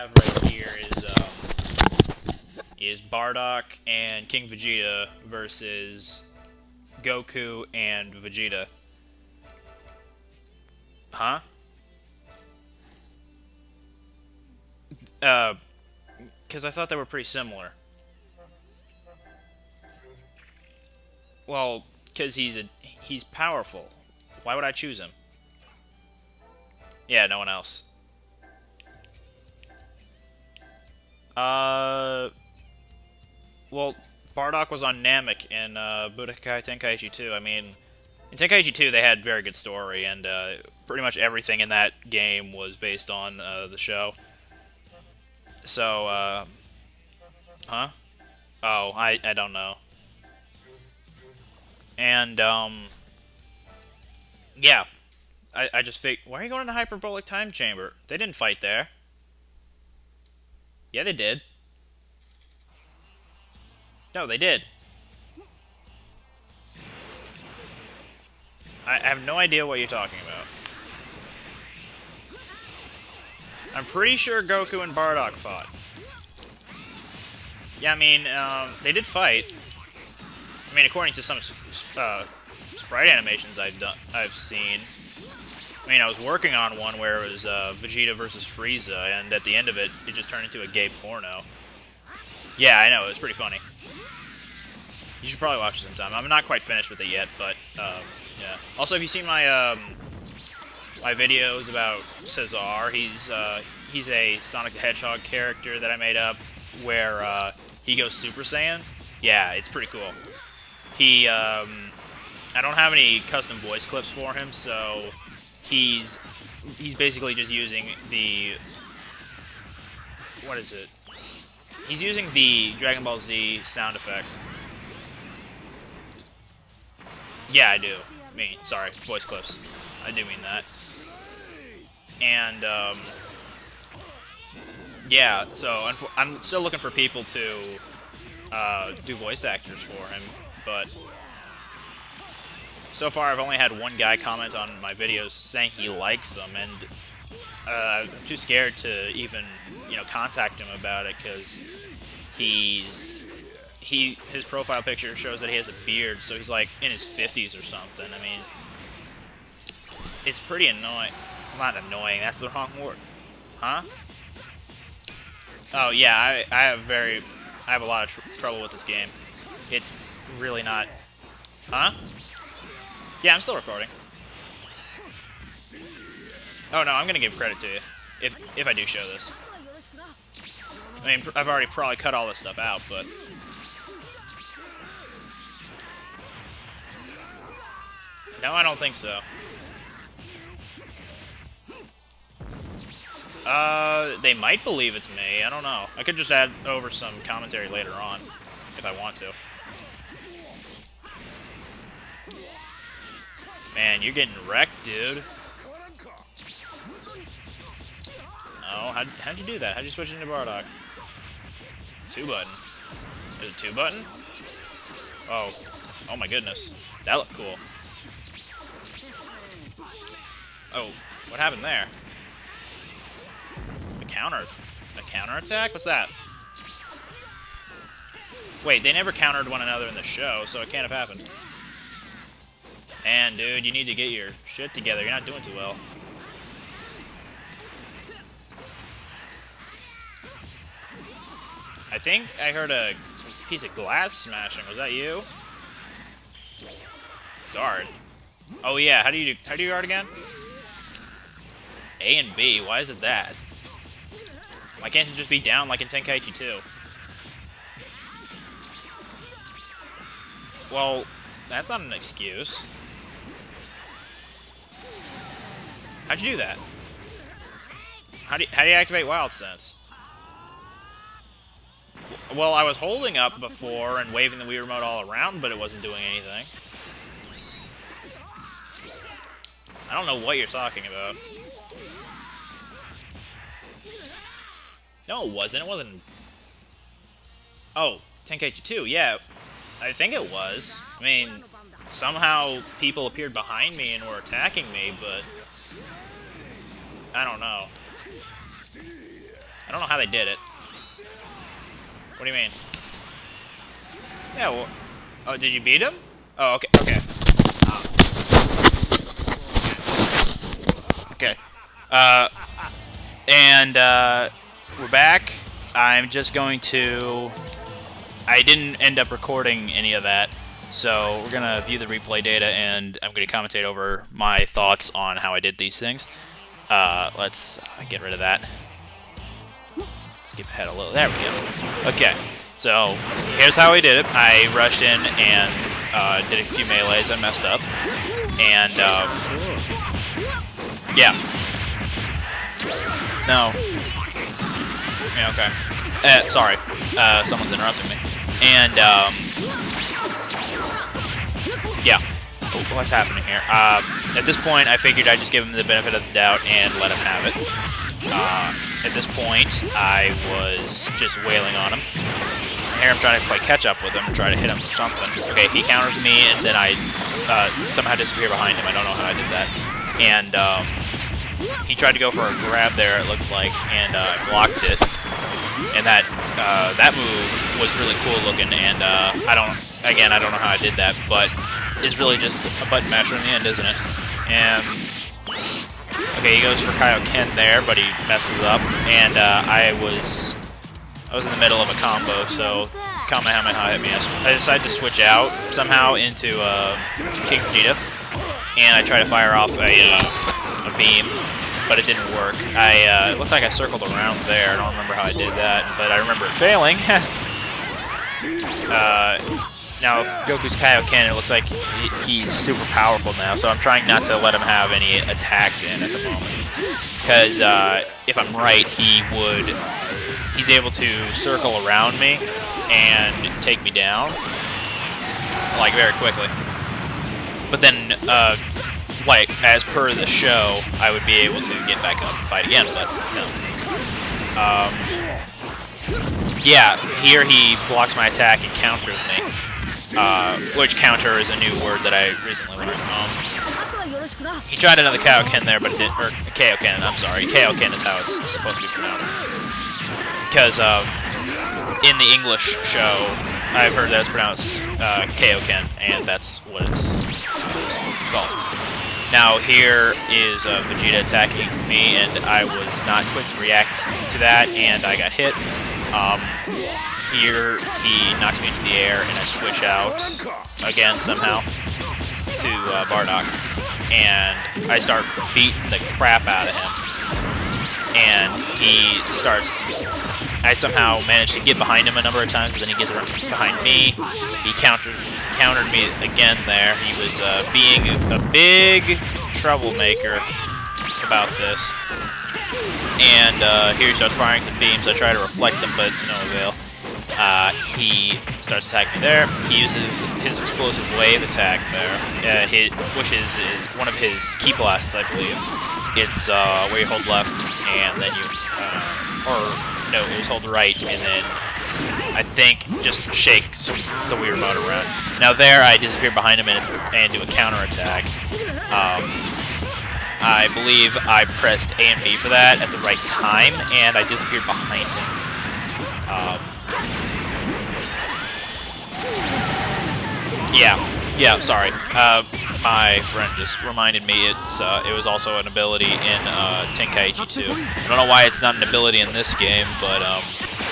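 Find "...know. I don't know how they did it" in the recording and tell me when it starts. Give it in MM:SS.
04:57.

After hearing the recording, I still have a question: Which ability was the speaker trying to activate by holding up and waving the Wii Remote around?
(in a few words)
Wild Sense.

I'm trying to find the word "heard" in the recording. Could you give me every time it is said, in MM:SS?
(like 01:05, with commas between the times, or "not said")
04:02, 07:33.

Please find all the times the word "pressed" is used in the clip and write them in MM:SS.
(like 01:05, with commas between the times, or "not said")
08:41.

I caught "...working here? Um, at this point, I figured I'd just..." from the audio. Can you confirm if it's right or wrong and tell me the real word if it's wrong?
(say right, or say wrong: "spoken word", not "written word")
wrong: "happening", not "working".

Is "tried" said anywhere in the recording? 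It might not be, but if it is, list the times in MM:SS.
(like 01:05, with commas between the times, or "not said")
06:11, 06:38, 07:24.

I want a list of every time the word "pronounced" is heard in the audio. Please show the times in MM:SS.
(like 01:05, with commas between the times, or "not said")
07:28, 07:34.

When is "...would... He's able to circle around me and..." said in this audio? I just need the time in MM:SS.
06:59.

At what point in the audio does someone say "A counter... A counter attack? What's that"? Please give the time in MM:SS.
03:44.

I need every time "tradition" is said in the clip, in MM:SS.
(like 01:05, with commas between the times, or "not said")
not said.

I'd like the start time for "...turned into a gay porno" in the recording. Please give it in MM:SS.
01:30.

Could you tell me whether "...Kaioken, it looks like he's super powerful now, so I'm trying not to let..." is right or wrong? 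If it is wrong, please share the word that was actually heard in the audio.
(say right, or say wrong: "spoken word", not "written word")
right.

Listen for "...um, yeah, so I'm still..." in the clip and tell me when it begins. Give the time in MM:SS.
02:12.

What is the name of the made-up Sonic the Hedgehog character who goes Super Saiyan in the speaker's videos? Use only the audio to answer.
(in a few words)
Cesar.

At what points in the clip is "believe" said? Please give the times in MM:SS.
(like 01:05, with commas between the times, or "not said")
03:14, 08:25, 08:40.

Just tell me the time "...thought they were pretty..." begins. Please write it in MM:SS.
00:16.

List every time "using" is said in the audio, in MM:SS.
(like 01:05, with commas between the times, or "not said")
01:57, 02:02.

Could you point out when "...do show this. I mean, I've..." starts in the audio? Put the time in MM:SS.
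02:58.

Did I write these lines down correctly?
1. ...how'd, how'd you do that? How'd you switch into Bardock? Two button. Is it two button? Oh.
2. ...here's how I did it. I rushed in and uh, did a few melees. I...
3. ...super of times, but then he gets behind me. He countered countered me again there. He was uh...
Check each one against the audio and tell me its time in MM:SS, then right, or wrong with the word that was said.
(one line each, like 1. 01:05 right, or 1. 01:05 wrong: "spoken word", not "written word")
1. 03:28 right
2. 05:33 right
3. 08:02 wrong: "number", not "super".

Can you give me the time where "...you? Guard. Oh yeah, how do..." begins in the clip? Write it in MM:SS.
04:04.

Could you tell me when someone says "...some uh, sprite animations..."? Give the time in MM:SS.
01:21.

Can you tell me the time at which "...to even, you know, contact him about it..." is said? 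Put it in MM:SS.
02:28.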